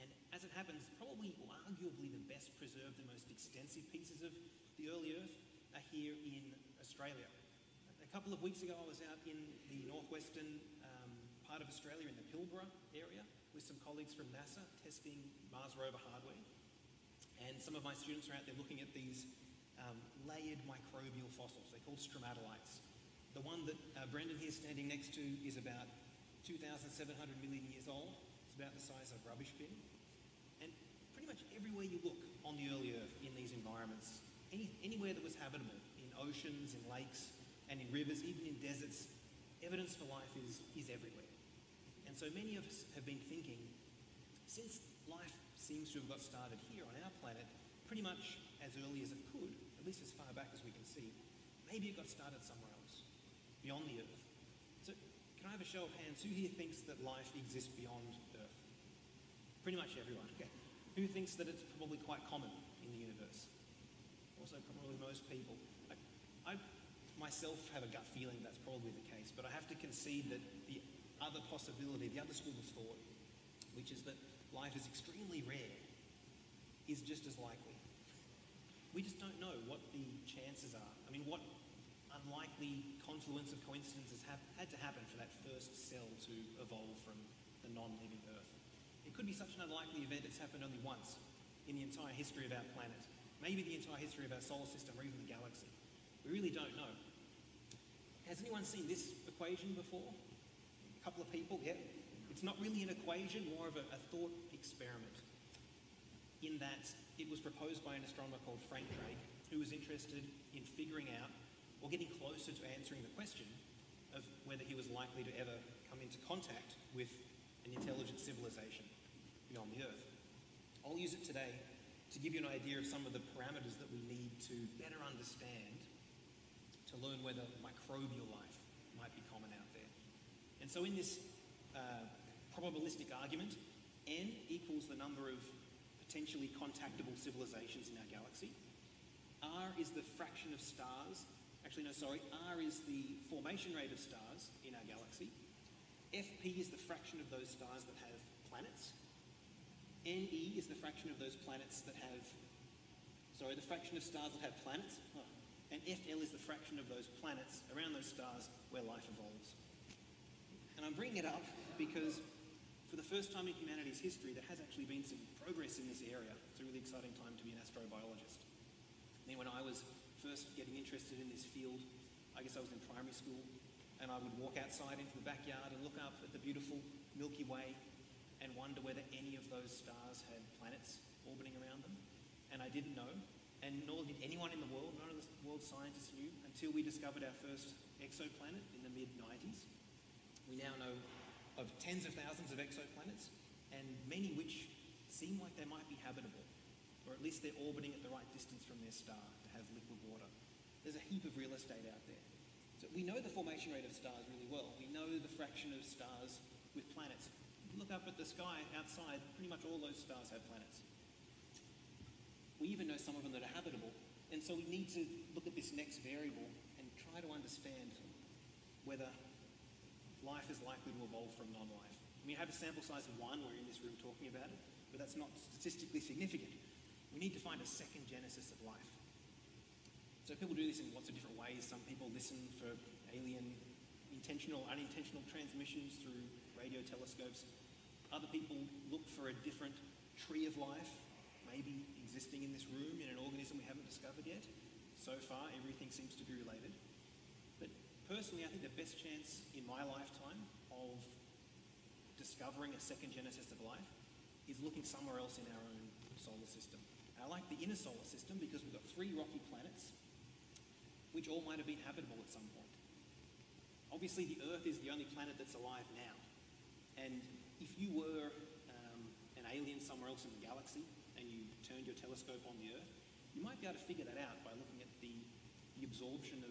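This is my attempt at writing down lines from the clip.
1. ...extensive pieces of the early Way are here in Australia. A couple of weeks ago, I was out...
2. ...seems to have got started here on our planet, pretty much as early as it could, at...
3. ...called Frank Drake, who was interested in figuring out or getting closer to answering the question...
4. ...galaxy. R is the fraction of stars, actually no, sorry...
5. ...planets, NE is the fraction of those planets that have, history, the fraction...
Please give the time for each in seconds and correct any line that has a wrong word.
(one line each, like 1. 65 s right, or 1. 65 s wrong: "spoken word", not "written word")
1. 3 s wrong: "Earth", not "Way"
2. 45 s right
3. 108 s right
4. 138 s right
5. 148 s wrong: "sorry", not "history".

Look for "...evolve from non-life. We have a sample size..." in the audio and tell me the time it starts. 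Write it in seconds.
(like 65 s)
221 s.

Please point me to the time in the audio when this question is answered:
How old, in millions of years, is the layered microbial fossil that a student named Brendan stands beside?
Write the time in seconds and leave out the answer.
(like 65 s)
26 s.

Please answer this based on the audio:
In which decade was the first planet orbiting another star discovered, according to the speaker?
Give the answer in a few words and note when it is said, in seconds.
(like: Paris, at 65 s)
mid 90s, at 188 s.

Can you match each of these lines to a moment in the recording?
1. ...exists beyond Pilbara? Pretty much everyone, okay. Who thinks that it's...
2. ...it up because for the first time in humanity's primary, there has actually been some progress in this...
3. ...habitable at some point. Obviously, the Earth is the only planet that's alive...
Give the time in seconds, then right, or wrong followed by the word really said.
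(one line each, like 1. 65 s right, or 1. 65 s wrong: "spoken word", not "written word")
1. 57 s wrong: "Earth", not "Pilbara"
2. 161 s wrong: "history", not "primary"
3. 261 s right.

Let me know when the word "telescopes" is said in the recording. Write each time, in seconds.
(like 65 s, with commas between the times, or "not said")
236 s, 271 s.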